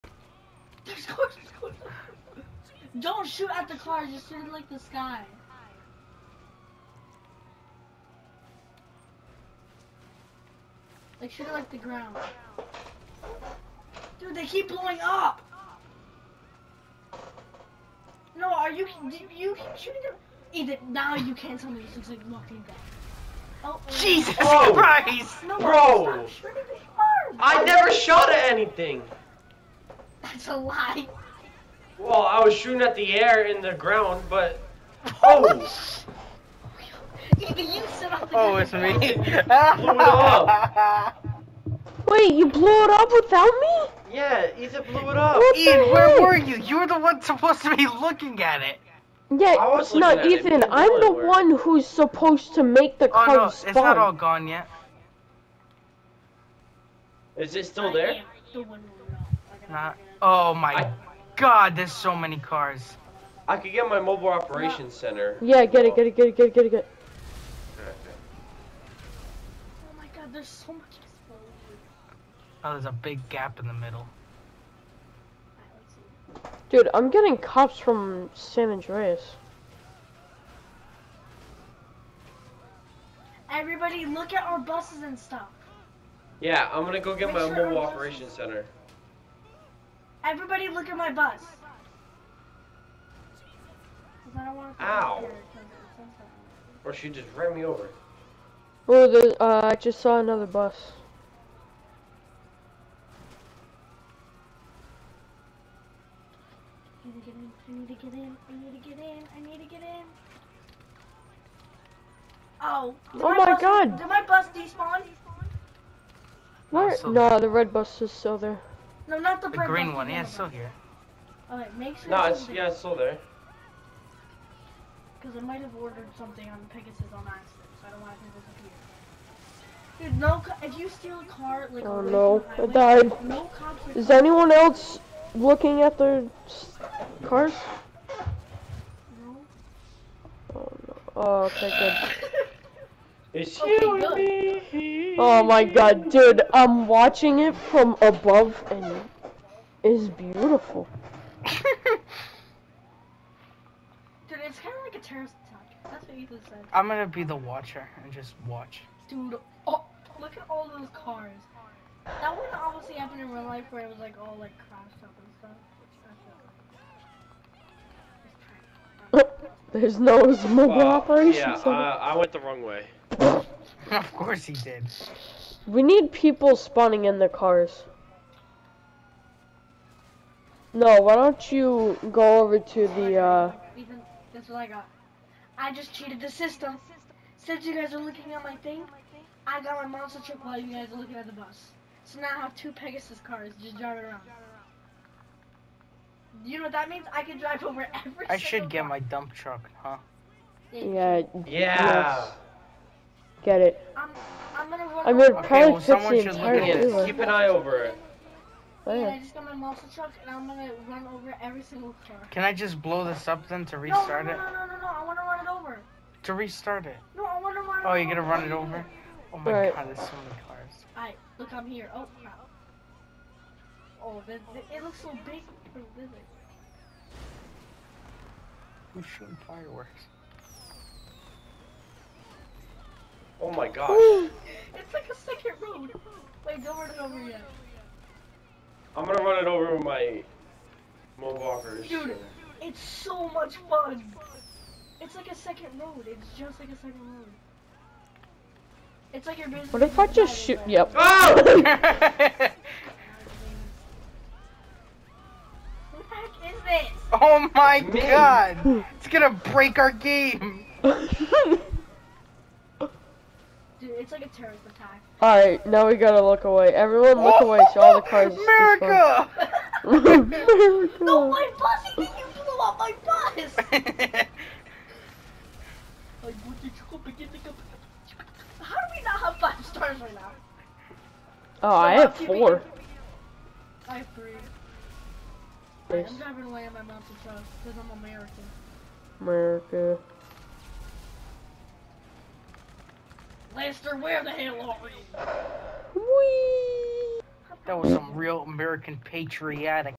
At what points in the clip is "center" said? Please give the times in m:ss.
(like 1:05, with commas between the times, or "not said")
1:04, 1:28.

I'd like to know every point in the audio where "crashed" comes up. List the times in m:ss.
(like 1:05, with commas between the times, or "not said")
2:44.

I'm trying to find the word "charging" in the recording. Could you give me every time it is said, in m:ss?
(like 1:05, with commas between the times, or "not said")
not said.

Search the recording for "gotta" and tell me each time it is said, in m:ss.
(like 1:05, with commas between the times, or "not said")
4:25.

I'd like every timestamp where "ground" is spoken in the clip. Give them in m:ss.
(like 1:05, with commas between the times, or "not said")
0:11, 0:33.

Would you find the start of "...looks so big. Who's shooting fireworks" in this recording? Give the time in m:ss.
3:44.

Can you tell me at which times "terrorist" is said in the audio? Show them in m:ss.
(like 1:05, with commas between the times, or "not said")
2:34, 4:24.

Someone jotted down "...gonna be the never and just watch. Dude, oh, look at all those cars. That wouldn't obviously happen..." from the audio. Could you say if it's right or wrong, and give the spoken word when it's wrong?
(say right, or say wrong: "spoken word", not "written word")
wrong: "watcher", not "never".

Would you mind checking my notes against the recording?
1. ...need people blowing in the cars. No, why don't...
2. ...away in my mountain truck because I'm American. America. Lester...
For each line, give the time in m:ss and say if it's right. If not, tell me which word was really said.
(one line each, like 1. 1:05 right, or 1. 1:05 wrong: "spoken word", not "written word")
1. 2:55 wrong: "spawning", not "blowing"
2. 4:46 right.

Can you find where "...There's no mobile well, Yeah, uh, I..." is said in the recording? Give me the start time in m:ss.
2:49.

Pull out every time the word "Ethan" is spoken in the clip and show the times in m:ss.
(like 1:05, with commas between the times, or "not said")
0:44, 0:50, 2:36.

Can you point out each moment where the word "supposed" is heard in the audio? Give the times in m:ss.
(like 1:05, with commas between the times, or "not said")
0:47, 0:51.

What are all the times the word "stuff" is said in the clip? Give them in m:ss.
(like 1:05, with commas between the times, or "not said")
1:25, 2:49.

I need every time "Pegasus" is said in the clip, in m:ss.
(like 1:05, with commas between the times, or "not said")
2:06, 3:12.